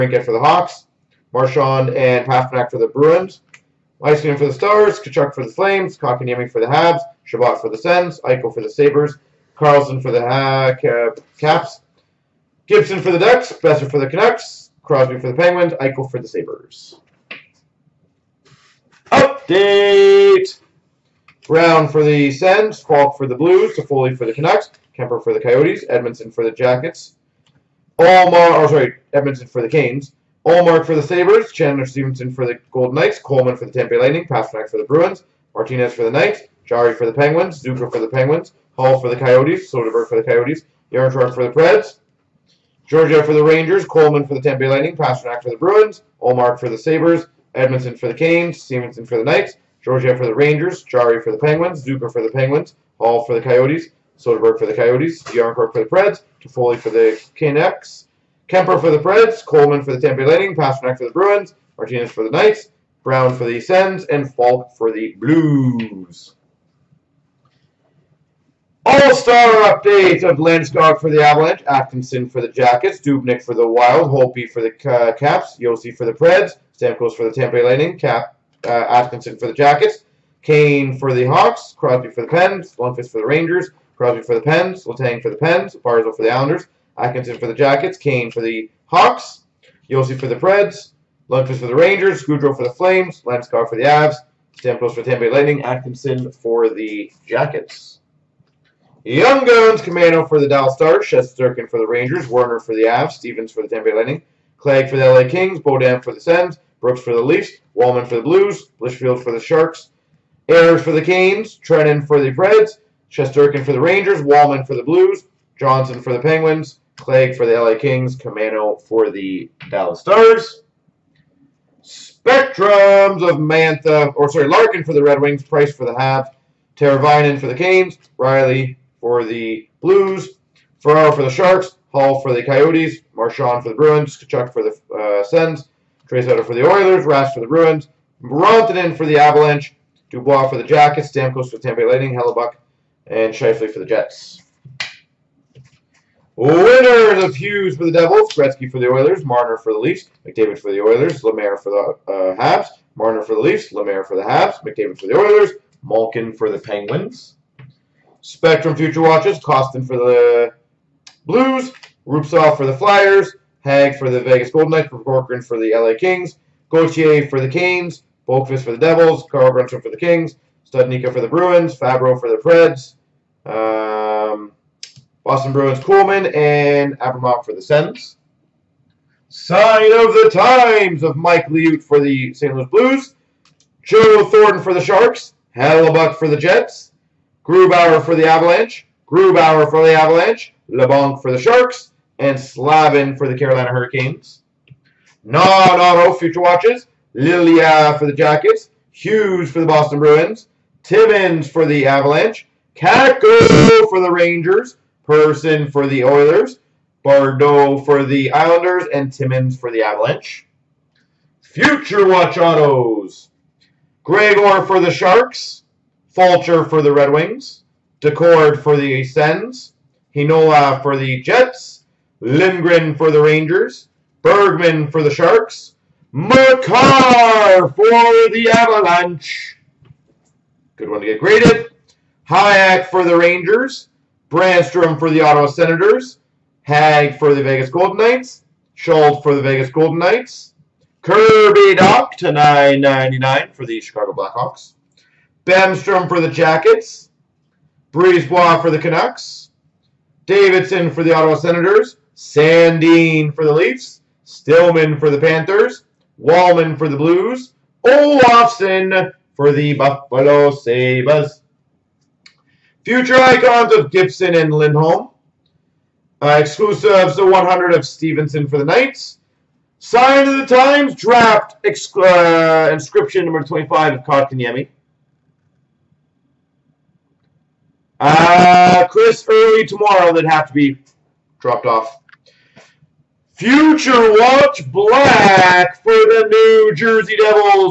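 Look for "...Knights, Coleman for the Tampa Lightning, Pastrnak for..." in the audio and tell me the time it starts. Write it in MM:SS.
00:32.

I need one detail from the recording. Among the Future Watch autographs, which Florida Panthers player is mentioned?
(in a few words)
Stillman.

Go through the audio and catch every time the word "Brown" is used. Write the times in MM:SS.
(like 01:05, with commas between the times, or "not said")
00:21, 01:03.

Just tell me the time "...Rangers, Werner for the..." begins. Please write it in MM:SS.
01:41.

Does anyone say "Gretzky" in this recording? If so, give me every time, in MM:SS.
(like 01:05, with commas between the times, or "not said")
02:28.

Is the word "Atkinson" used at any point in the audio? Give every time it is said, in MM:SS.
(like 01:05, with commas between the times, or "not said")
01:11, 01:18, 01:26, 01:35.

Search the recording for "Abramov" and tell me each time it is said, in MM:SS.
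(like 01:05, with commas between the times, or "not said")
02:56.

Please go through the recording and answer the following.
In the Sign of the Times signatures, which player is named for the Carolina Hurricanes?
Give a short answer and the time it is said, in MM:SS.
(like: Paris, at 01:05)
Slavin, at 03:12.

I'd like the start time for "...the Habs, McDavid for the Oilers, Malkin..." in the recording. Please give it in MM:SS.
02:34.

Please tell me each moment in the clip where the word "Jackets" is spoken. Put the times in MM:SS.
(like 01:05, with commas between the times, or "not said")
00:26, 01:12, 01:19, 01:27, 01:37, 02:20, 03:18, 04:06.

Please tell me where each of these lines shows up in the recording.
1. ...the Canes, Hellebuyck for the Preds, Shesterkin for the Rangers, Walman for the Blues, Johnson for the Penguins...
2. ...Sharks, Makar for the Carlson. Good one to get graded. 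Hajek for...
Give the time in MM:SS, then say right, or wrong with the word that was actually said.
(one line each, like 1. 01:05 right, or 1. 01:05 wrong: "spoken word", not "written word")
1. 01:50 wrong: "Trenin", not "Hellebuyck"
2. 03:45 wrong: "Avalanche", not "Carlson".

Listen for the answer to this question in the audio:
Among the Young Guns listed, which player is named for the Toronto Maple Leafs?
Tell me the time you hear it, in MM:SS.
01:46.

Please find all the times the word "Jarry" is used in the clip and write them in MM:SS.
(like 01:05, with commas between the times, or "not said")
00:36, 00:50.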